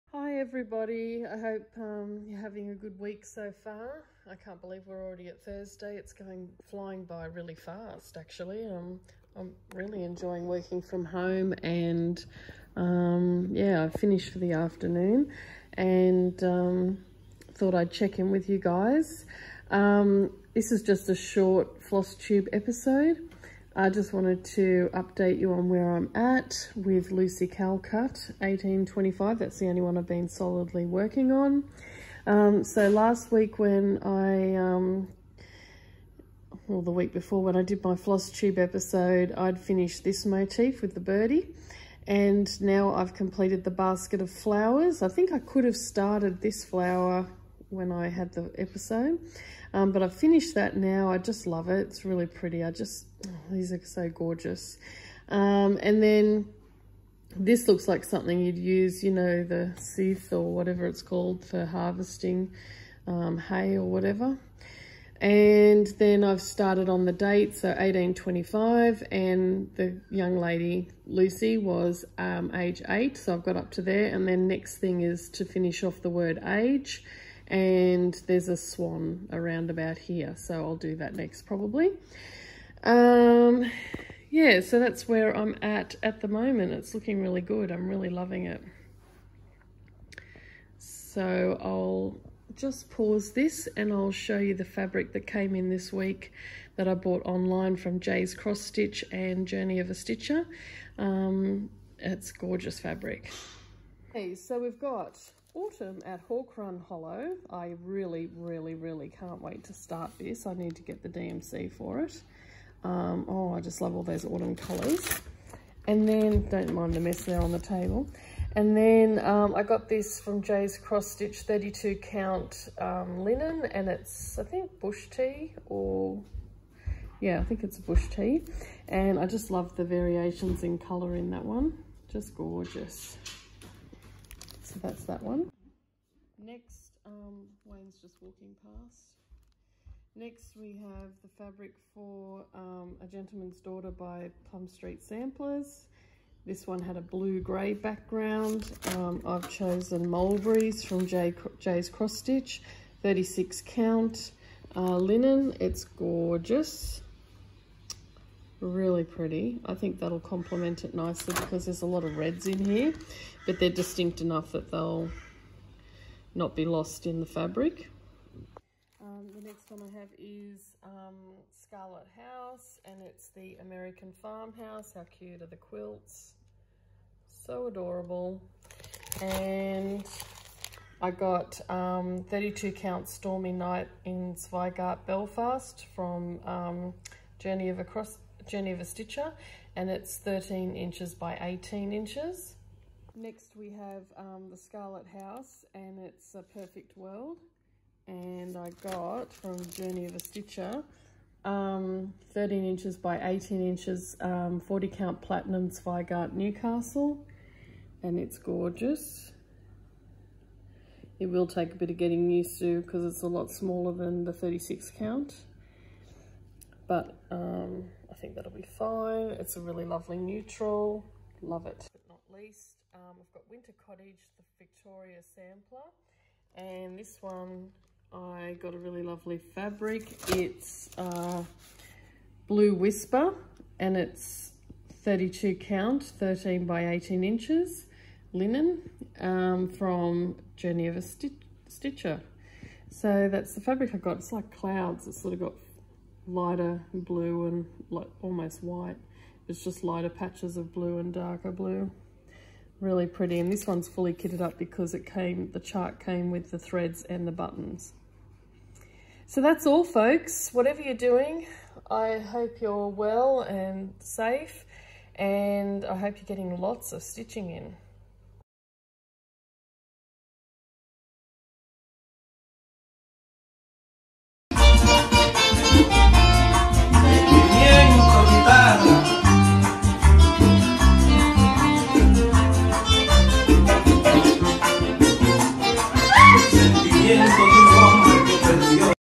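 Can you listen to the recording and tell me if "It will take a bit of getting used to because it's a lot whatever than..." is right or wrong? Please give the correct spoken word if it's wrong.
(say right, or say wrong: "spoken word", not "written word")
wrong: "smaller", not "whatever".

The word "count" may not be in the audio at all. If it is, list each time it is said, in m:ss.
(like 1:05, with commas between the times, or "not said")
2:01, 2:33, 3:02, 3:24, 3:34, 3:55.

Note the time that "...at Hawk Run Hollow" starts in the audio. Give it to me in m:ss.
1:46.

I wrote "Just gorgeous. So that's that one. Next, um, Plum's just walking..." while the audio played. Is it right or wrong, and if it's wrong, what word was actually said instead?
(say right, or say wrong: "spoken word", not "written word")
wrong: "Wayne", not "Plum".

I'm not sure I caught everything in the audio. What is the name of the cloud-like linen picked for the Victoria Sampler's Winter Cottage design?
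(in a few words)
Blue Whisper.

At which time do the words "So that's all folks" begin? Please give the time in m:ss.
4:19.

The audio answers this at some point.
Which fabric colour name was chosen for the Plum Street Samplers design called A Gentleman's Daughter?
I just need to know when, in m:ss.
2:30.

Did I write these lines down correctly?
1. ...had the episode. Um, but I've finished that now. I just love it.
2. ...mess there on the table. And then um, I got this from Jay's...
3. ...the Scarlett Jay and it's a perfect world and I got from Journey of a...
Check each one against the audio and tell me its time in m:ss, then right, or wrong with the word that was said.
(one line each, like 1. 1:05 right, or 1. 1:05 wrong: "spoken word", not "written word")
1. 0:48 right
2. 1:56 right
3. 3:14 wrong: "House", not "Jay".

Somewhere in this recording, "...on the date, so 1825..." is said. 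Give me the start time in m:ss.
1:06.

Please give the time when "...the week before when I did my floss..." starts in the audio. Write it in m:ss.
0:36.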